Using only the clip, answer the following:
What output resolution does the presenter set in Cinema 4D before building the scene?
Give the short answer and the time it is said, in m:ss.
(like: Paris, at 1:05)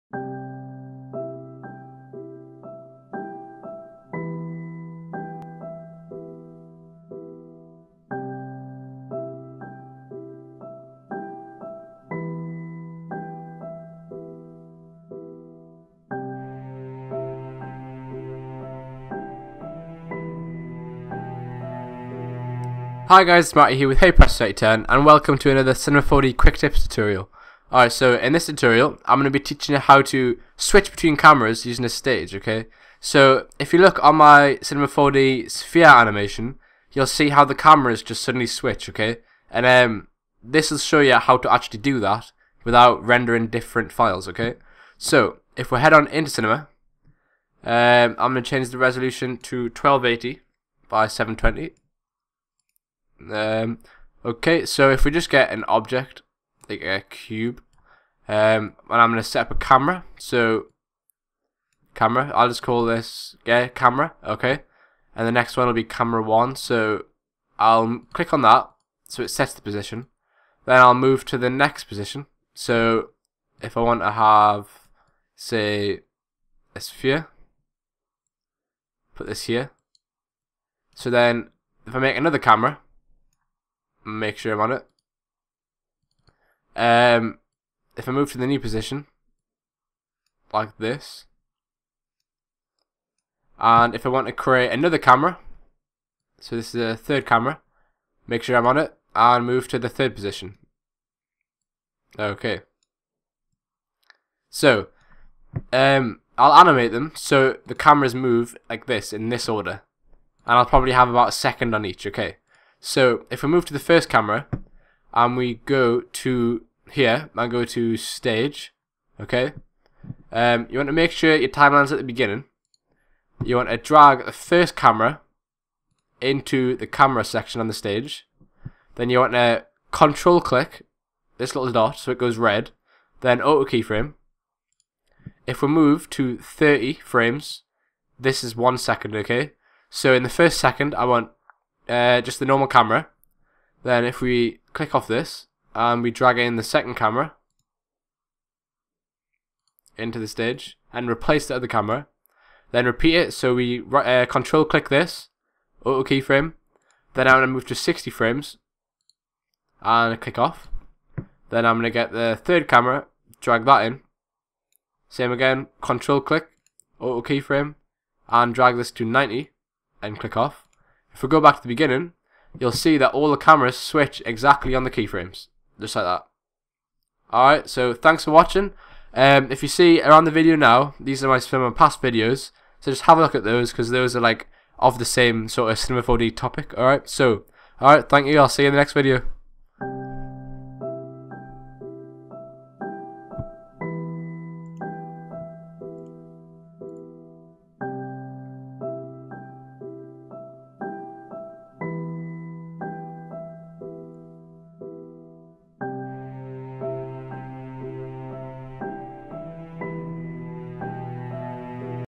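1280 by 720, at 0:49.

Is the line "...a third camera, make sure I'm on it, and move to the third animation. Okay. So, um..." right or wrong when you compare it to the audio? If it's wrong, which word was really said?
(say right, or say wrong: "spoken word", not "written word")
wrong: "position", not "animation".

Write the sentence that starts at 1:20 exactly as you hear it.
So then, if I make another camera, make sure I'm on it.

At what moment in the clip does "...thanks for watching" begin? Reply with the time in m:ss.
2:57.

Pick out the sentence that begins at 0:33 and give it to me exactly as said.
So, if you look on my Cinema 4D sphere animation, you'll see how the cameras just suddenly switch, okay?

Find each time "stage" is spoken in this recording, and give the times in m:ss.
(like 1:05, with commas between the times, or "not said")
0:31, 1:57, 2:07, 2:30.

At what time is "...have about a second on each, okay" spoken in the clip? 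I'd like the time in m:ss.
1:50.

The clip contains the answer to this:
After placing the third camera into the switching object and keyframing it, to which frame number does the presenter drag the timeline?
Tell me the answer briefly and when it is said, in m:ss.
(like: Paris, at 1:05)
90, at 2:49.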